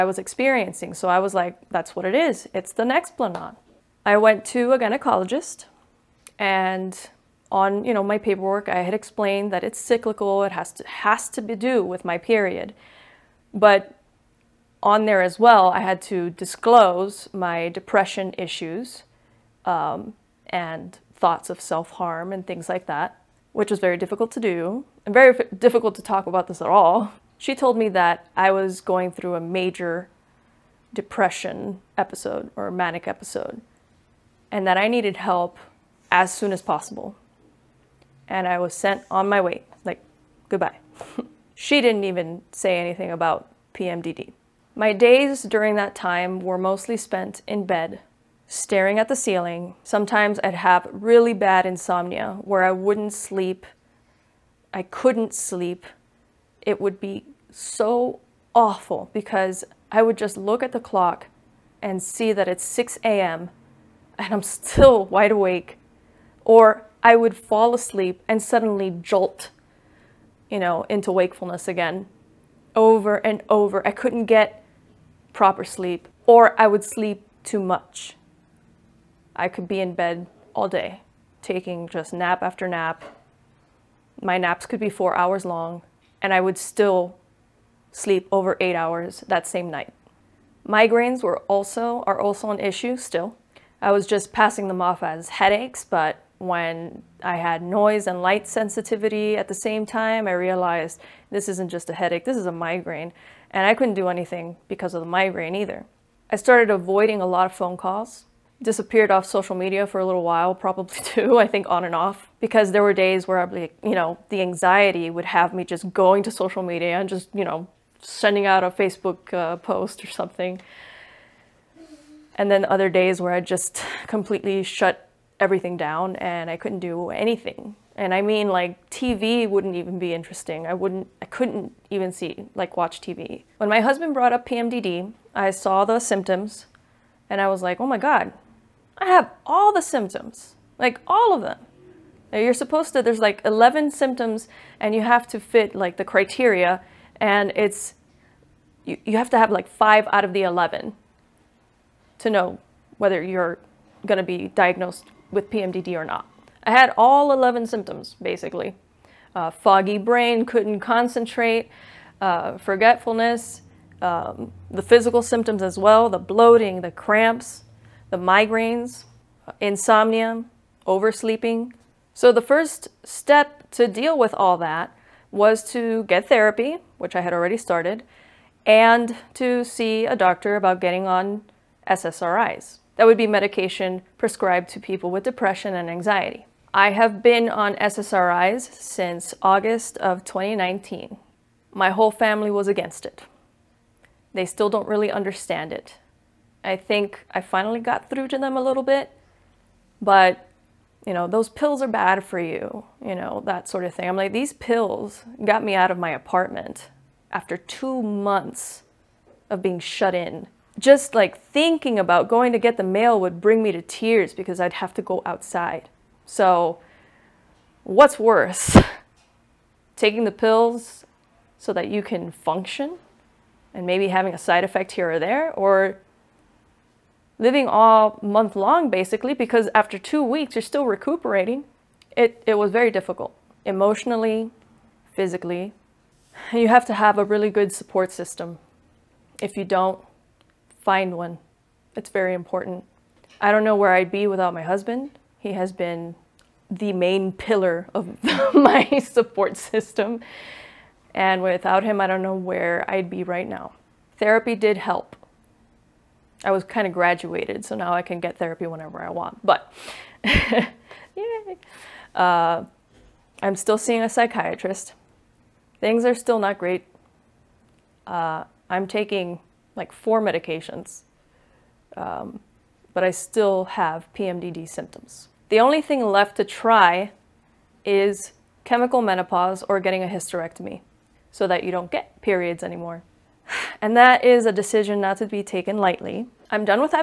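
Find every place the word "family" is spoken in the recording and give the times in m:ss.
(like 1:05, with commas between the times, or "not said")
3:12.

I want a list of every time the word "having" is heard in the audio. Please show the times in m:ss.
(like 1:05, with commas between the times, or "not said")
3:44.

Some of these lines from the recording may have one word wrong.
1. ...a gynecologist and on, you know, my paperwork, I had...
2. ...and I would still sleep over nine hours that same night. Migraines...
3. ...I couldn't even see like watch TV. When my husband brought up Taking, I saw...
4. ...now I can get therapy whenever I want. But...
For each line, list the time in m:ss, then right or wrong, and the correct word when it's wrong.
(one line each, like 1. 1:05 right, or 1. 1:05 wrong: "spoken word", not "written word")
1. 0:04 right
2. 1:26 wrong: "eight", not "nine"
3. 2:11 wrong: "PMDD", not "Taking"
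4. 4:17 right.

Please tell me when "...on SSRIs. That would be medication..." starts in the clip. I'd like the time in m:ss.
3:01.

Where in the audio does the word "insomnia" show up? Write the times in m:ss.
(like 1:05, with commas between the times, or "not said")
0:51, 2:49.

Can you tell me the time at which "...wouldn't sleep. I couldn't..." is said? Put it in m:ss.
0:52.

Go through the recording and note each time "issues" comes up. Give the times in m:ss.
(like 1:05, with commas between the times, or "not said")
0:18, 1:32.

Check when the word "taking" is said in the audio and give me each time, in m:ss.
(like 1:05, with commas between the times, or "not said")
1:21, 3:39, 4:28.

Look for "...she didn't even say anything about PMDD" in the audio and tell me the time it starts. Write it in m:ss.
0:41.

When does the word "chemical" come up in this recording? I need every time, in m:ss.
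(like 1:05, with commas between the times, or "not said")
4:38.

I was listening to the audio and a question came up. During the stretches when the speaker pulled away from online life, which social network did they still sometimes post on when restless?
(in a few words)
Facebook.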